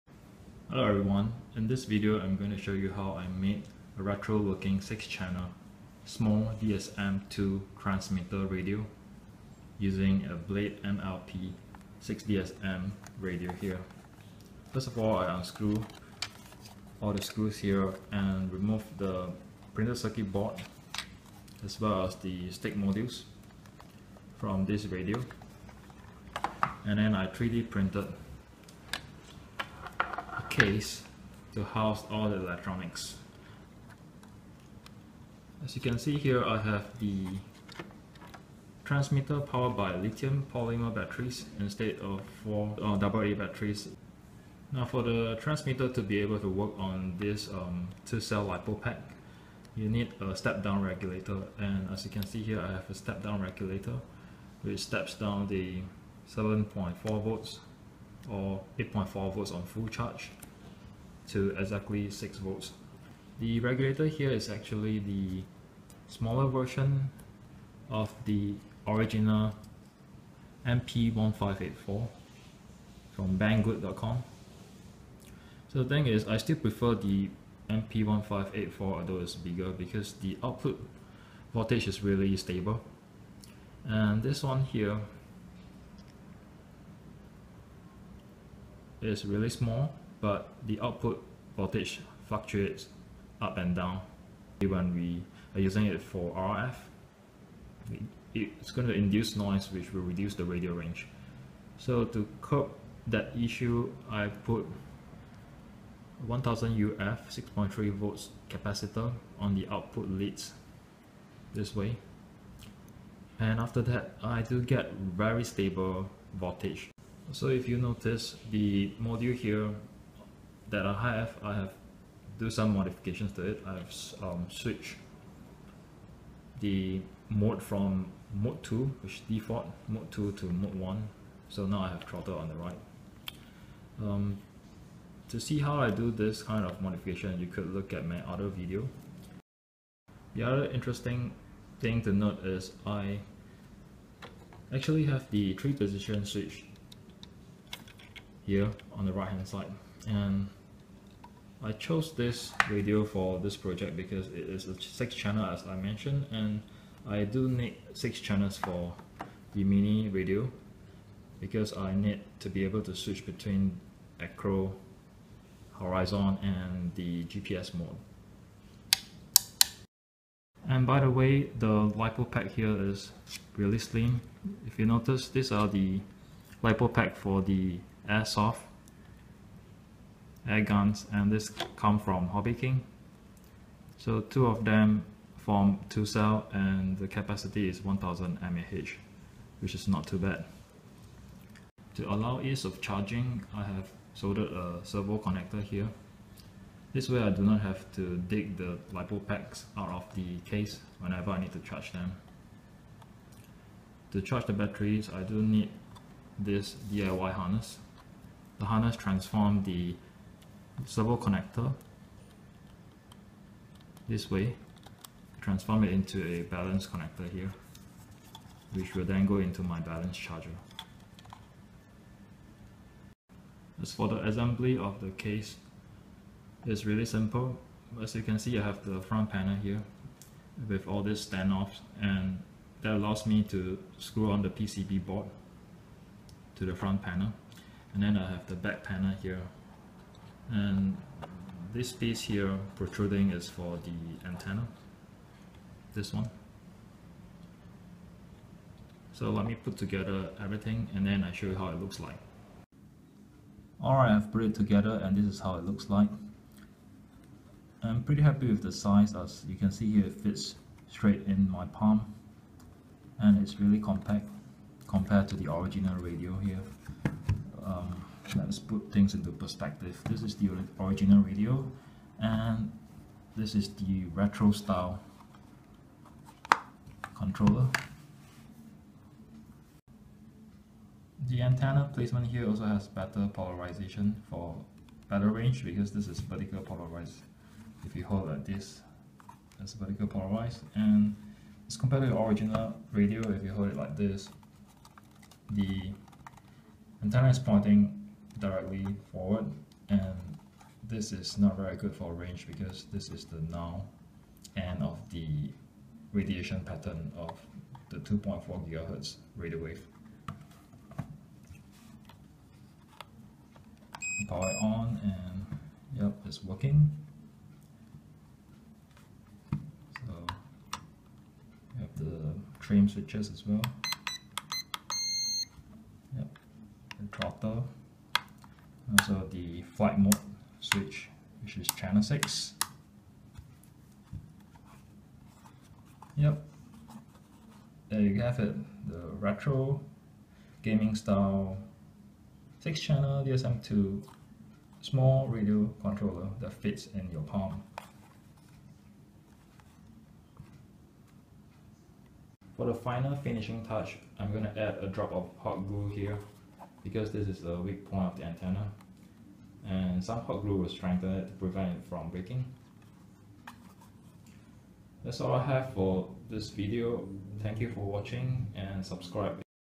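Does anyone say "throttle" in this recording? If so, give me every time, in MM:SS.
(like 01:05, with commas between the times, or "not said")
02:12, 05:27.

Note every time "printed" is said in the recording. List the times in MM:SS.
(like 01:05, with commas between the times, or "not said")
00:19, 00:27.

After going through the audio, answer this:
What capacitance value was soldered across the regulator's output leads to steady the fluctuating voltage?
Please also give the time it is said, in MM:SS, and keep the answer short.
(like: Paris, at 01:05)
1000 uF, at 01:46.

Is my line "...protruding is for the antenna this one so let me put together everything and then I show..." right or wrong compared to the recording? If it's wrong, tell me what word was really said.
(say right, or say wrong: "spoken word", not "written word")
right.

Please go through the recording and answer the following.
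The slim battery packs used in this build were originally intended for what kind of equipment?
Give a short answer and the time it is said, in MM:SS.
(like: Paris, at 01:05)
Airsoft air guns, at 02:58.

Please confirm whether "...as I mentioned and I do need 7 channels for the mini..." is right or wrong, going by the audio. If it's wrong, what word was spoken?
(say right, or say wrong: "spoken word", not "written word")
wrong: "6", not "7".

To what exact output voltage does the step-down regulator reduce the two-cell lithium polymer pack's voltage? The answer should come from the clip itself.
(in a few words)
6 volts.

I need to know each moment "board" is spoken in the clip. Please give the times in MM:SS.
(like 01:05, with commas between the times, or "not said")
00:20, 03:55.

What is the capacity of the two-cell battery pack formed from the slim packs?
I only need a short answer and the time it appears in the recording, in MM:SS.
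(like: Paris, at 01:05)
1000 mAh, at 03:07.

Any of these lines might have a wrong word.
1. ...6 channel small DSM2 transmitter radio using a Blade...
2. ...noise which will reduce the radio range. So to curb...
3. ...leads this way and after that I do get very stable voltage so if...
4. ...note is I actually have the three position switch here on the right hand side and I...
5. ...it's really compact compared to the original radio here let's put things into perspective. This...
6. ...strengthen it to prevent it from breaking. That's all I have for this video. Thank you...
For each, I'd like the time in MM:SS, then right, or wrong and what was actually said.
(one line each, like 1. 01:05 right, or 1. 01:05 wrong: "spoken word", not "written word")
1. 00:04 right
2. 01:39 right
3. 01:50 right
4. 02:22 right
5. 04:23 right
6. 06:00 right.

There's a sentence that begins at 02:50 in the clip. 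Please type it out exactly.
And by the way, the LiPo pack here is really slim.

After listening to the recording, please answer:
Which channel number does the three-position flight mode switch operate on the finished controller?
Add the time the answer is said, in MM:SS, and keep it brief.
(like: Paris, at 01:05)
6, at 05:31.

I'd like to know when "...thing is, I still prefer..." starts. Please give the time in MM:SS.
01:15.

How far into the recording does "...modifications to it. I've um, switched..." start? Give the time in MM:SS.
02:02.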